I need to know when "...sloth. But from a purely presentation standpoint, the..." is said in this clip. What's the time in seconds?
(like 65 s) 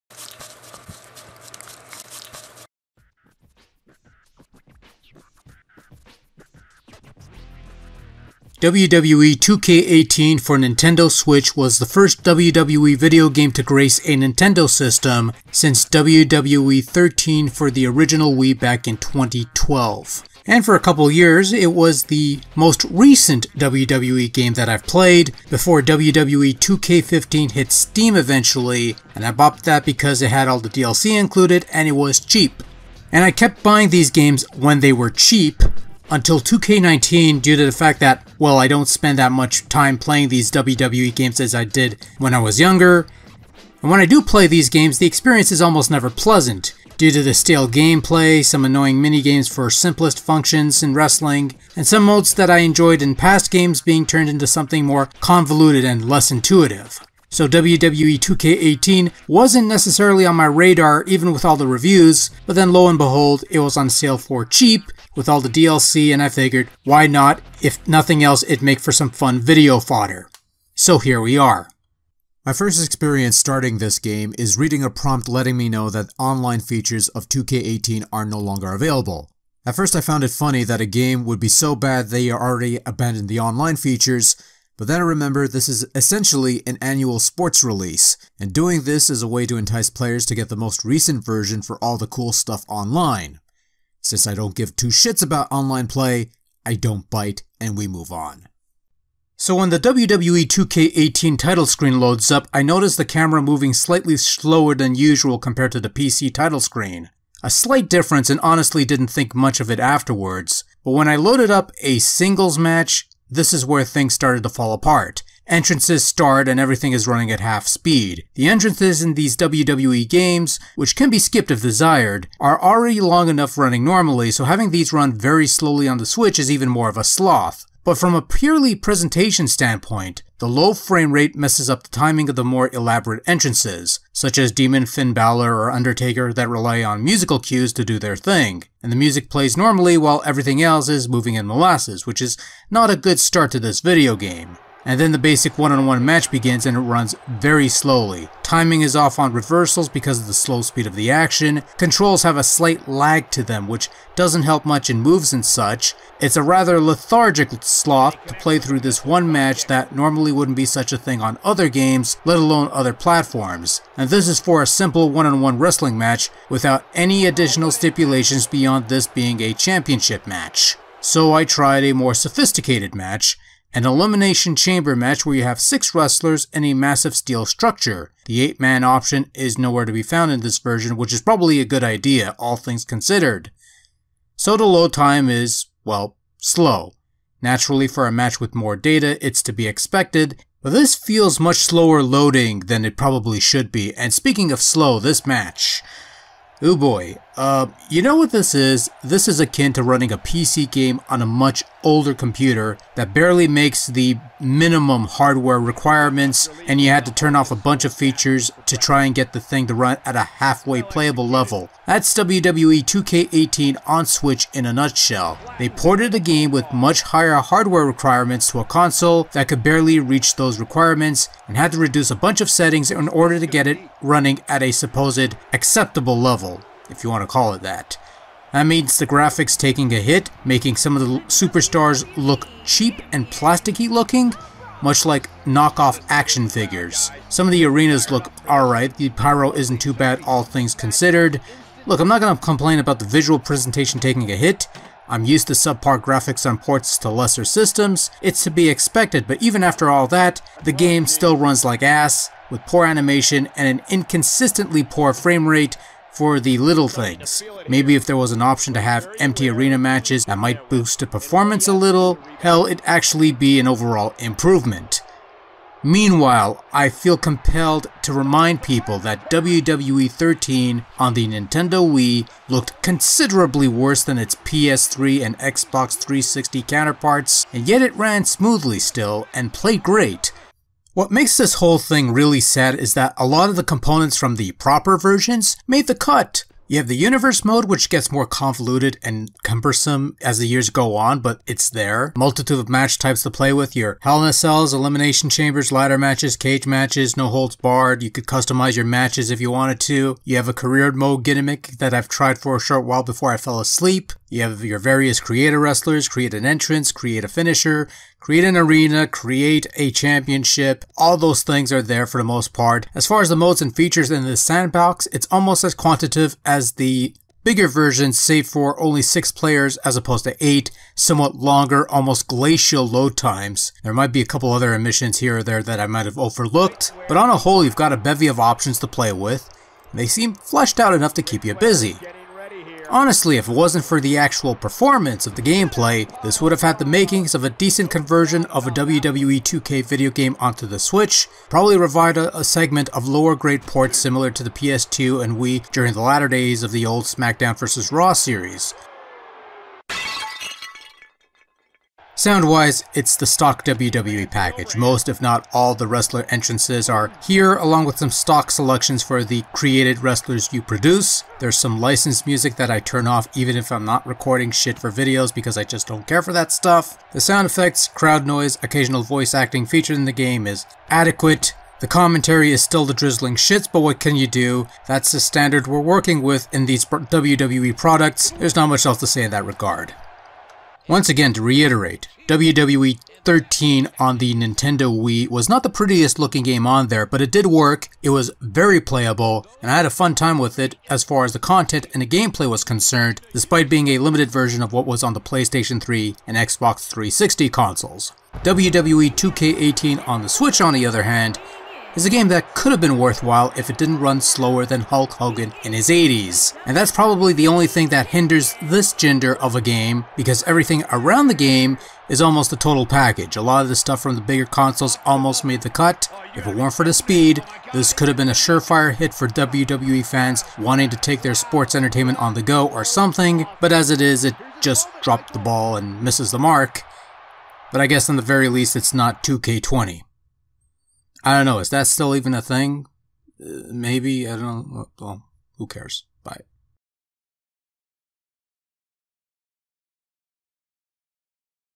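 127 s.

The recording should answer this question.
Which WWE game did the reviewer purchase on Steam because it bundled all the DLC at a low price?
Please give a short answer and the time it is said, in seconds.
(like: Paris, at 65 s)
WWE 2K15, at 25 s.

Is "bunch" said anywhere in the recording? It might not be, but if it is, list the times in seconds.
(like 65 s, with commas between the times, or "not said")
207 s, 222 s.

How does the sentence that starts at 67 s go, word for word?
If nothing else, it'd make for some fun video fodder.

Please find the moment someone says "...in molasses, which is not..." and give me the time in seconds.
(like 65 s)
141 s.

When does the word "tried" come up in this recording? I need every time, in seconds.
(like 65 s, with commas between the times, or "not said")
171 s, 302 s.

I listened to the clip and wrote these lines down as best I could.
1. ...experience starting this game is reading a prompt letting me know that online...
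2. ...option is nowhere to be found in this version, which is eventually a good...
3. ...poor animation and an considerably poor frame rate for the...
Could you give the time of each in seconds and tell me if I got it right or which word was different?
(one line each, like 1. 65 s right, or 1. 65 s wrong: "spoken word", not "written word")
1. 72 s right
2. 178 s wrong: "probably", not "eventually"
3. 252 s wrong: "inconsistently", not "considerably".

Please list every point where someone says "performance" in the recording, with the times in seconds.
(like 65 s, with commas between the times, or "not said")
261 s, 334 s.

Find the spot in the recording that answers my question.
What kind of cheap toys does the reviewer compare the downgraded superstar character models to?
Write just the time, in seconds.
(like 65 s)
235 s.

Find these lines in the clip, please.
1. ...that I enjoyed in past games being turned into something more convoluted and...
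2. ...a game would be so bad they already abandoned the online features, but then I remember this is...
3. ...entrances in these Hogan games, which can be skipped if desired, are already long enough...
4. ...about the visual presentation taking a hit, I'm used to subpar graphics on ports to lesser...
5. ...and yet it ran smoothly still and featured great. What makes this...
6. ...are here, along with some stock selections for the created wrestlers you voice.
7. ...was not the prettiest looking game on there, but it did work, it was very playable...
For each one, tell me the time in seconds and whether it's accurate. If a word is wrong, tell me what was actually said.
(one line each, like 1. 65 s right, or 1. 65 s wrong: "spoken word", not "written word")
1. 52 s right
2. 80 s right
3. 118 s wrong: "WWE", not "Hogan"
4. 242 s right
5. 277 s wrong: "played", not "featured"
6. 356 s wrong: "produce", not "voice"
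7. 385 s right.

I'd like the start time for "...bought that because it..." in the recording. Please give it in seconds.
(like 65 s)
29 s.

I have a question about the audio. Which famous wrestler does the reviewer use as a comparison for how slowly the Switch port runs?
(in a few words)
Hulk Hogan.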